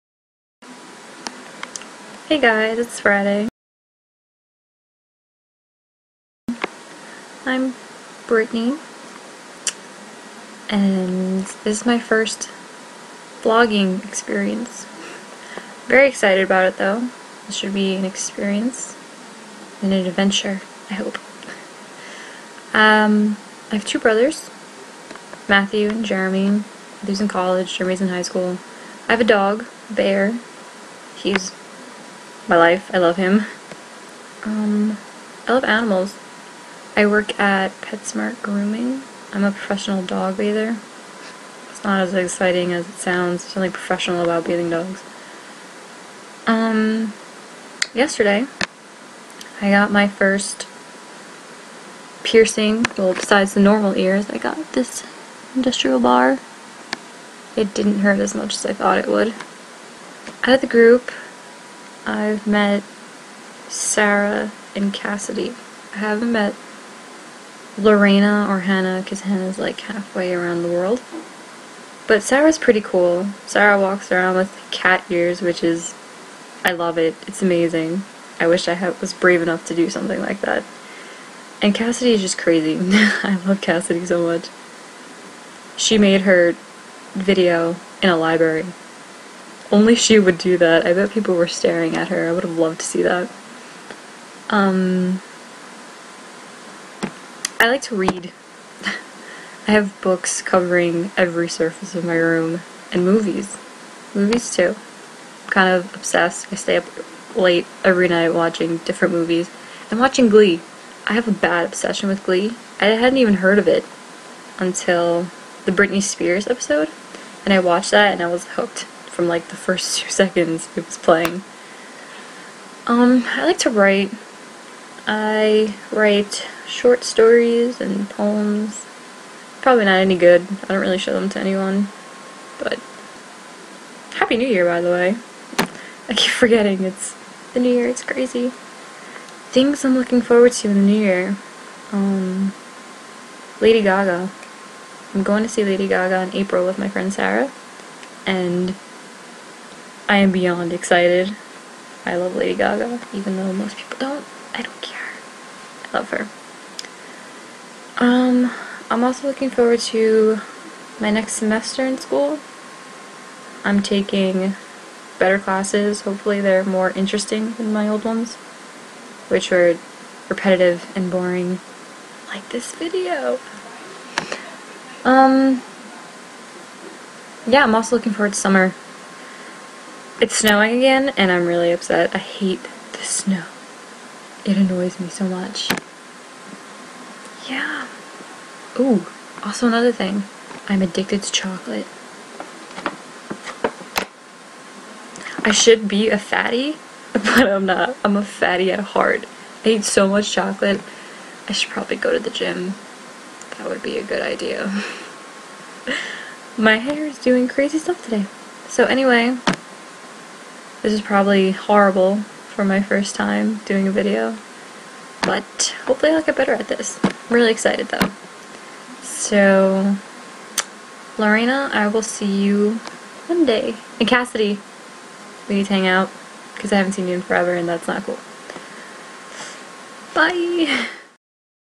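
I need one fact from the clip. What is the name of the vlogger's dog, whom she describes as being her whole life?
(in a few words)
Bear.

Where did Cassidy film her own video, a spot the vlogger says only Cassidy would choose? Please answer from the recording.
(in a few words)
a library.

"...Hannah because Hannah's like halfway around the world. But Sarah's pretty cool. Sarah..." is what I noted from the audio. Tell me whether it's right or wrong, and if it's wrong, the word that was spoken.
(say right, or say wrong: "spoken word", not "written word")
right.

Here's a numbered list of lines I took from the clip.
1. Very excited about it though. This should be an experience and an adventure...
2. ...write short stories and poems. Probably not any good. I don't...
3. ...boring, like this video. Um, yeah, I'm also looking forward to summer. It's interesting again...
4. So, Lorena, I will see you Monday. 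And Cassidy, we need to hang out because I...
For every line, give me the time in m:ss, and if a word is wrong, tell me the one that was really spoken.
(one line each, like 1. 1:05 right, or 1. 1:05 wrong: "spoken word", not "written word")
1. 0:15 right
2. 2:05 right
3. 2:51 wrong: "snowing", not "interesting"
4. 3:39 right.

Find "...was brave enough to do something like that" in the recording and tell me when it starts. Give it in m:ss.
1:19.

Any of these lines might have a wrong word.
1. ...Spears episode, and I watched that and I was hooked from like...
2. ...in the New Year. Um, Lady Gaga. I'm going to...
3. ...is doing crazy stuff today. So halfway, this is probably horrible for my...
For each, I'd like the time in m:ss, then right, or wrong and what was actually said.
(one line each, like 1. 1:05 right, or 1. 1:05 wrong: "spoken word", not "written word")
1. 1:56 right
2. 2:20 right
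3. 3:27 wrong: "anyway", not "halfway".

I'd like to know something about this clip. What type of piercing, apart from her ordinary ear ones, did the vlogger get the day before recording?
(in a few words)
industrial bar.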